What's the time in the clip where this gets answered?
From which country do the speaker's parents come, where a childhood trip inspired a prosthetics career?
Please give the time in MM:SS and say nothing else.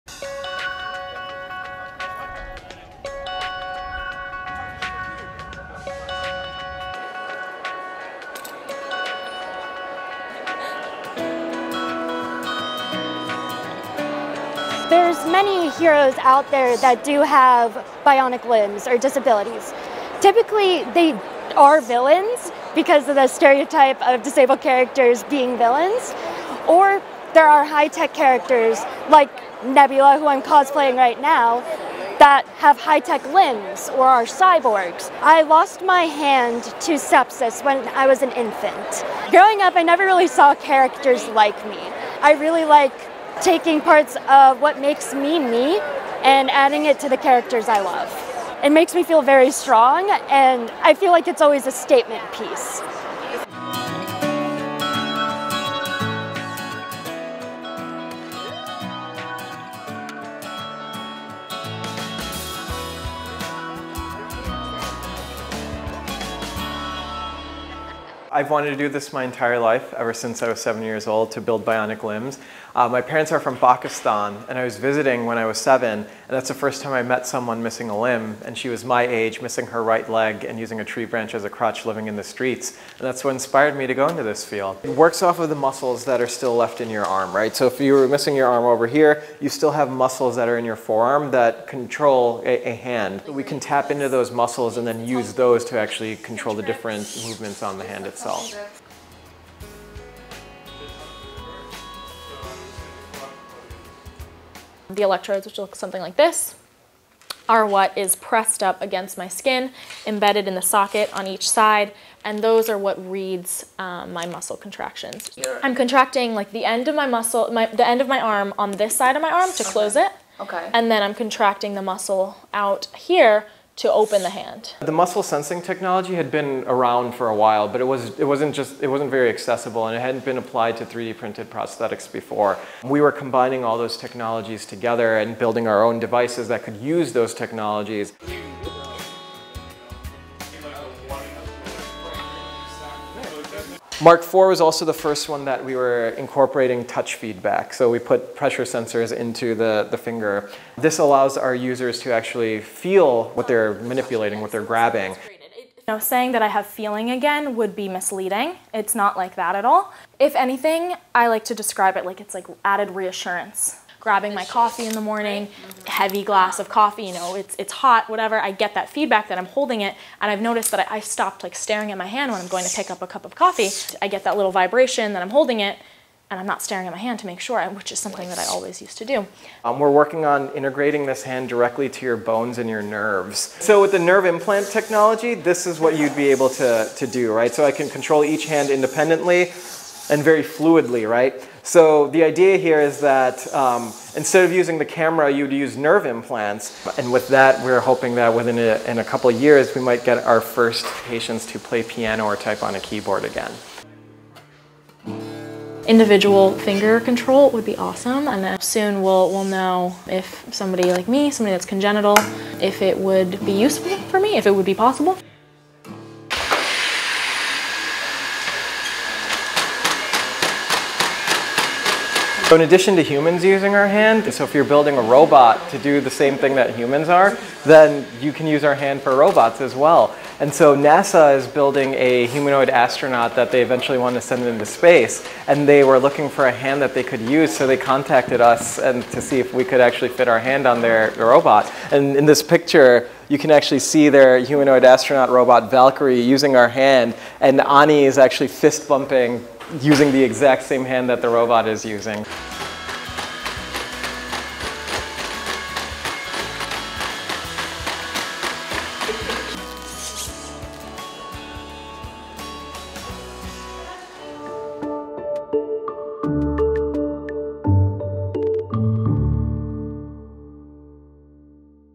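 01:13.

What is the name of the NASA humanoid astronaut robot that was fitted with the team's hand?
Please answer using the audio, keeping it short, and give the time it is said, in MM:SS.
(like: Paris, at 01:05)
Valkyrie, at 04:05.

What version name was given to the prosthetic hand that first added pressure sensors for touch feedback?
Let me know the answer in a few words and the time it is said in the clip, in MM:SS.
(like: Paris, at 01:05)
Mark IV, at 02:24.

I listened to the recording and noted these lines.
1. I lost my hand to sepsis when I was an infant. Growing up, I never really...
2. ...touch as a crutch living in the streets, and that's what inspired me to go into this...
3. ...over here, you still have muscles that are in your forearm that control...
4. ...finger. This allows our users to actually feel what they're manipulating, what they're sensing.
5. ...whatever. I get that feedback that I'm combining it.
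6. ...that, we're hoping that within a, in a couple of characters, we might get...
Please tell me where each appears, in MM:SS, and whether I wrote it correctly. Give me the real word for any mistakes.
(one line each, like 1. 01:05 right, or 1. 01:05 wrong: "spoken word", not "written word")
1. 00:35 right
2. 01:21 wrong: "branch", not "touch"
3. 01:28 right
4. 02:29 wrong: "grabbing", not "sensing"
5. 02:48 wrong: "holding", not "combining"
6. 03:17 wrong: "years", not "characters".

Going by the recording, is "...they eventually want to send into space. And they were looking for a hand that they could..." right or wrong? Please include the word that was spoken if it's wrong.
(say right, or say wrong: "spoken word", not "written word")
right.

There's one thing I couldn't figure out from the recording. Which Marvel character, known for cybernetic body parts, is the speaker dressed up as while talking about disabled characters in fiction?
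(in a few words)
Nebula.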